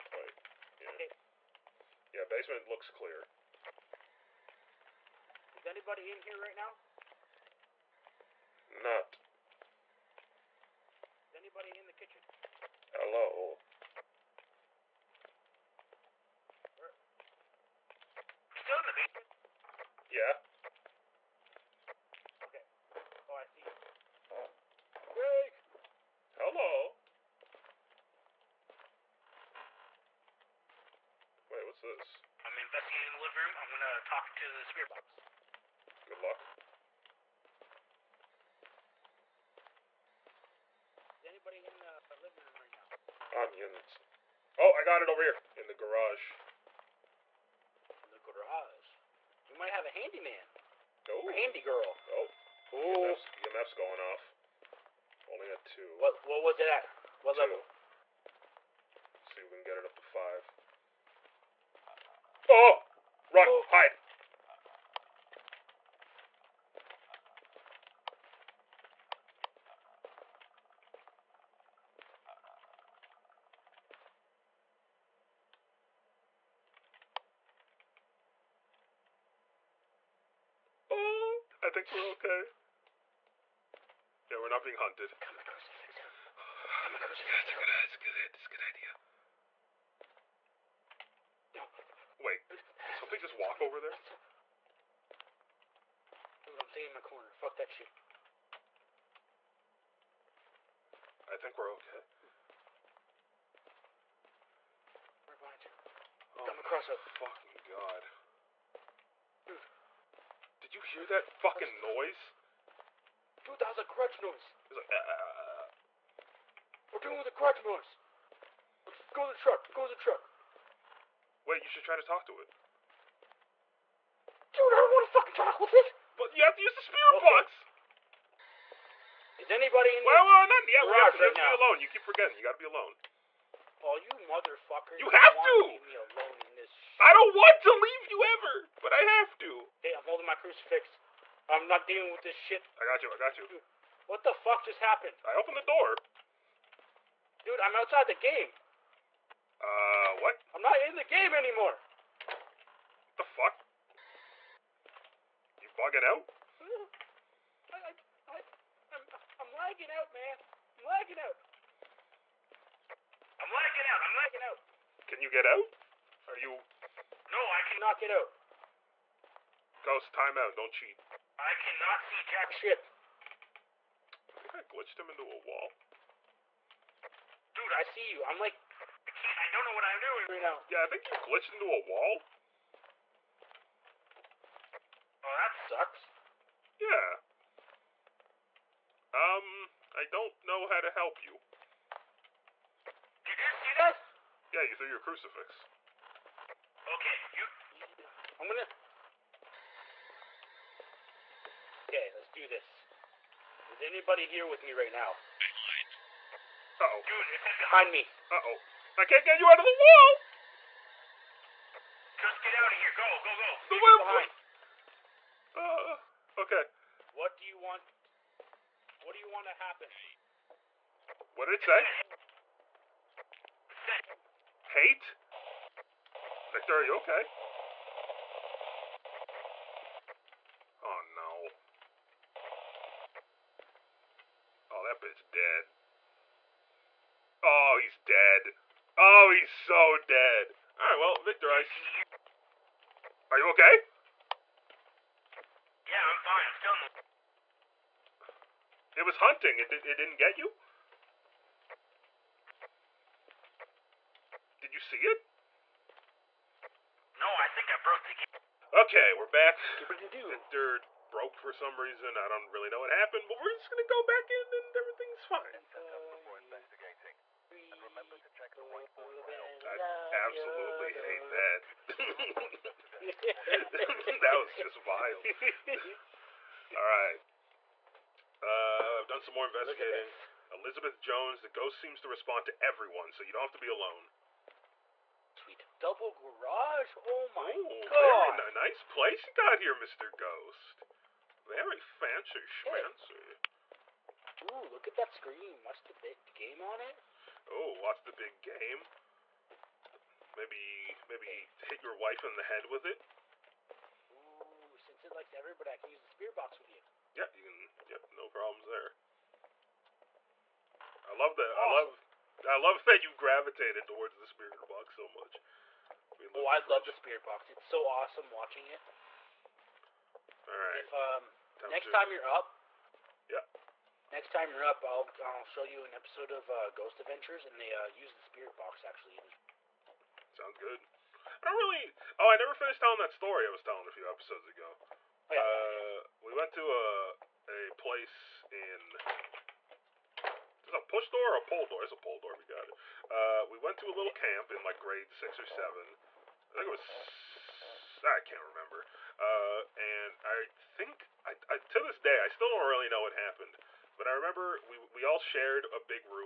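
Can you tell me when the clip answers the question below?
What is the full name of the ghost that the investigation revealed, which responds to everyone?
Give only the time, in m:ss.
4:40.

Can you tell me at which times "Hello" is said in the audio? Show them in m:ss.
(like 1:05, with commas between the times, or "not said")
0:12, 0:26.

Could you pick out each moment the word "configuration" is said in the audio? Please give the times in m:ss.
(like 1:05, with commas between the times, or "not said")
not said.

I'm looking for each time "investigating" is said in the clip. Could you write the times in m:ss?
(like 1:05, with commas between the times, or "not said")
0:32, 4:39.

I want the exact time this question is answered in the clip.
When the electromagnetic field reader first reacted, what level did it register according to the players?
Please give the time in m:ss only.
0:55.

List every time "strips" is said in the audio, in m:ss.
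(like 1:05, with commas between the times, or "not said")
not said.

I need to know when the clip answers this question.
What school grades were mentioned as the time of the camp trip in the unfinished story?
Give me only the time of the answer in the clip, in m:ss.
5:44.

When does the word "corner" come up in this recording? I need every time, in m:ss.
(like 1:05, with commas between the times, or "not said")
1:37.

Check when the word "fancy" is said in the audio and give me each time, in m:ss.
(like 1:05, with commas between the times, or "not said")
4:51.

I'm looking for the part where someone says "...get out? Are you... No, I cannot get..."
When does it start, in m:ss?
2:45.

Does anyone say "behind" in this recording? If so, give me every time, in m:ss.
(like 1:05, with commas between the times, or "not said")
1:45, 3:27, 3:35.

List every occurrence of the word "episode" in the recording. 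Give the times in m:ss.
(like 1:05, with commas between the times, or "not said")
5:25, 5:34.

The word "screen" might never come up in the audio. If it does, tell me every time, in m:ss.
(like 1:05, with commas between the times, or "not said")
4:55.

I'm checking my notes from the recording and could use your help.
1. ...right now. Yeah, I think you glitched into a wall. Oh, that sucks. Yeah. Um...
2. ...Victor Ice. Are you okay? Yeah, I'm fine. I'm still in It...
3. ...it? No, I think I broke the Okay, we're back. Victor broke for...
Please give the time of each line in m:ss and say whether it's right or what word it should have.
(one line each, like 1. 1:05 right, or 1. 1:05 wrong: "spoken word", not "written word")
1. 3:00 right
2. 4:01 right
3. 4:14 right.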